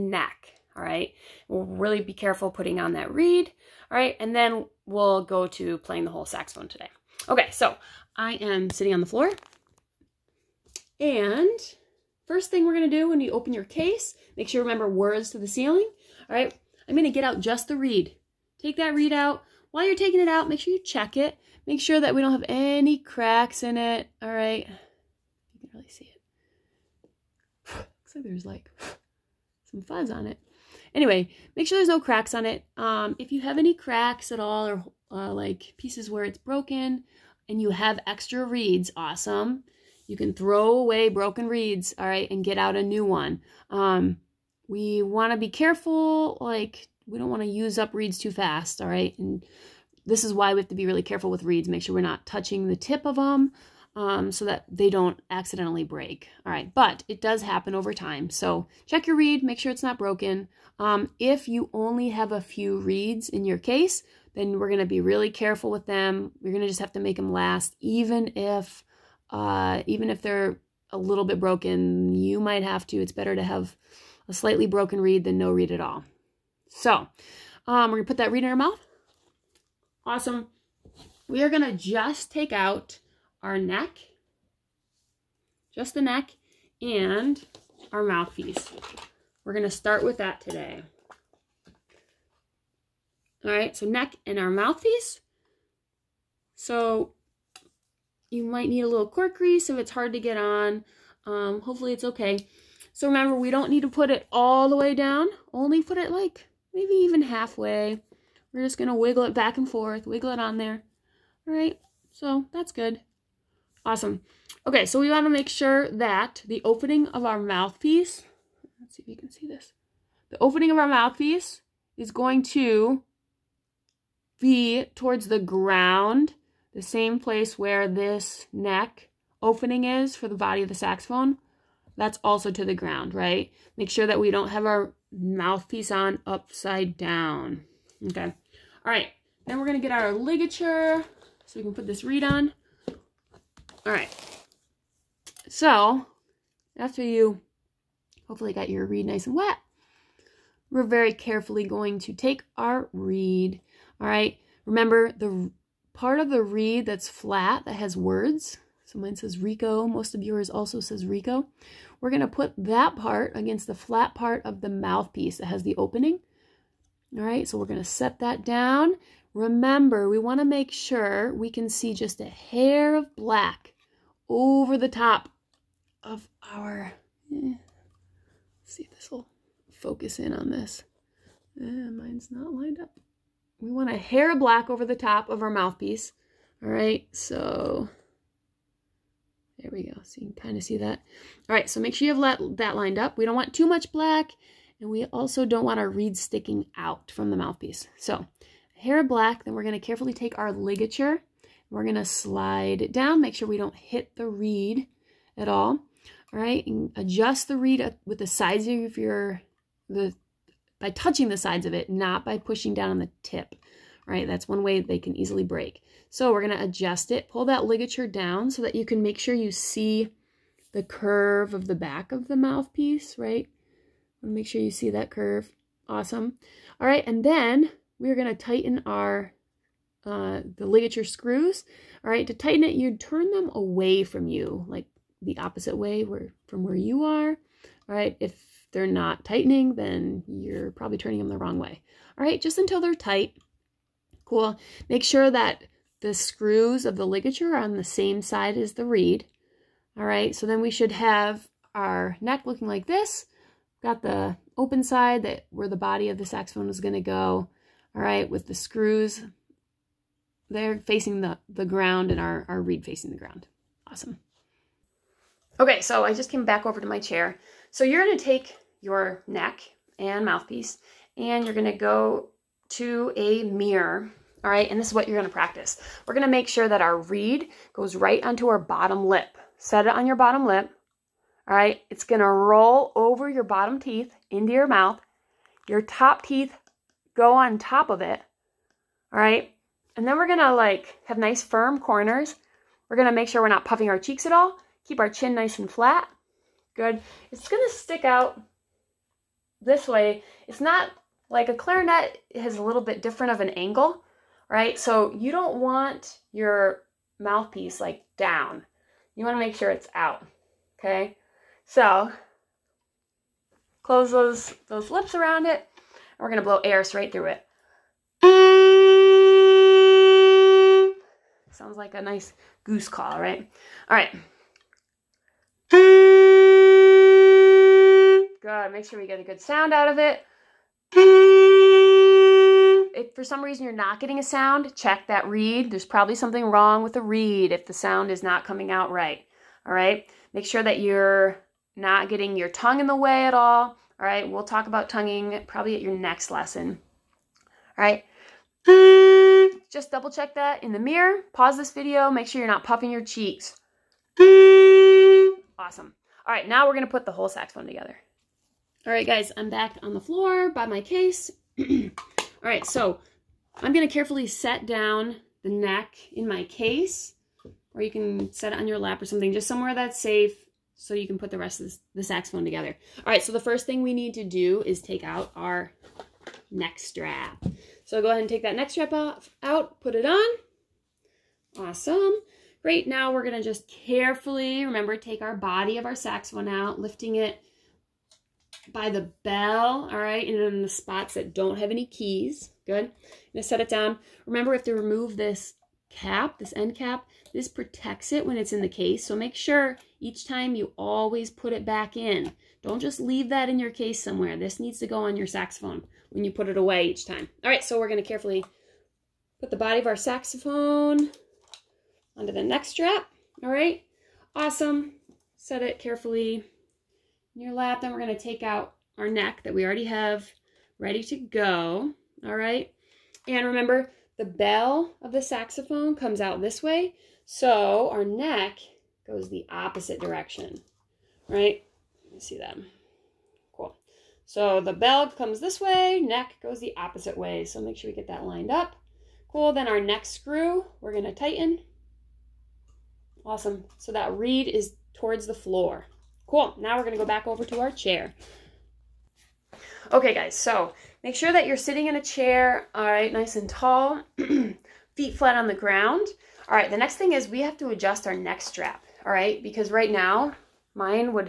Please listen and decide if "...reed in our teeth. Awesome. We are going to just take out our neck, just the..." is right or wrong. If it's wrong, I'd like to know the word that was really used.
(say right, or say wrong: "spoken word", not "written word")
wrong: "mouth", not "teeth".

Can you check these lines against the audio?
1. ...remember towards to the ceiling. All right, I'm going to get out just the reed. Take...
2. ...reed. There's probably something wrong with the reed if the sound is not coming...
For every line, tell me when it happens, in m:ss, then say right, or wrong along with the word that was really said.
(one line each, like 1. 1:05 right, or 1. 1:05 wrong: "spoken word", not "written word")
1. 0:14 wrong: "words", not "towards"
2. 5:35 right.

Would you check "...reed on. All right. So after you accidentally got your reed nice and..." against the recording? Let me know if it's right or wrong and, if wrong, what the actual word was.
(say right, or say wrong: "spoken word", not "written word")
wrong: "hopefully", not "accidentally".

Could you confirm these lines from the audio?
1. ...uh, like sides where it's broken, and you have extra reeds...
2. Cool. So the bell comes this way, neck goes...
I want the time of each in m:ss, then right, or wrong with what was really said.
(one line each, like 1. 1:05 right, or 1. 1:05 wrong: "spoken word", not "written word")
1. 0:35 wrong: "pieces", not "sides"
2. 7:13 right.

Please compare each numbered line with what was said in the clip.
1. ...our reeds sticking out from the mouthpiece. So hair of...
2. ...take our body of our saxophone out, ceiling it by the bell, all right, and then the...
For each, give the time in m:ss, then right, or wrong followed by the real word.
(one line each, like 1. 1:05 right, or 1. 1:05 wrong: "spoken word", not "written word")
1. 3:15 right
2. 6:24 wrong: "lifting", not "ceiling".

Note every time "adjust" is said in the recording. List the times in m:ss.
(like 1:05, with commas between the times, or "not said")
3:26, 3:36, 7:37.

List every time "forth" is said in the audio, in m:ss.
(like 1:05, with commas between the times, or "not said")
1:49.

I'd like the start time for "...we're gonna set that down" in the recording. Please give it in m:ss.
2:47.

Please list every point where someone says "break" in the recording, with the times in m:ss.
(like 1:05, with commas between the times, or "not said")
0:55, 3:35.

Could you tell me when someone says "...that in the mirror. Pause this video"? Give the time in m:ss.
5:50.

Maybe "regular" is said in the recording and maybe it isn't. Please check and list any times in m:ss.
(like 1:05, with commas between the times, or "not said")
not said.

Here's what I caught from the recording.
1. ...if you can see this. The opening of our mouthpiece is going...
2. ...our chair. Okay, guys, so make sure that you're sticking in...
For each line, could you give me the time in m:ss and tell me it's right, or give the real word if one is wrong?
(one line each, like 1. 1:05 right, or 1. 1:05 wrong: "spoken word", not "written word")
1. 1:59 right
2. 7:27 wrong: "sitting", not "sticking".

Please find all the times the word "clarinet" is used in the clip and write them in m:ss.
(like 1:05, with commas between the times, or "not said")
5:01.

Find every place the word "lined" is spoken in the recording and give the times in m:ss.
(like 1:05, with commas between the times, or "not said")
3:02, 3:12, 7:18.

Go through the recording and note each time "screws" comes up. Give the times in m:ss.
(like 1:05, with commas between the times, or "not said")
3:51, 4:06, 4:18, 7:20.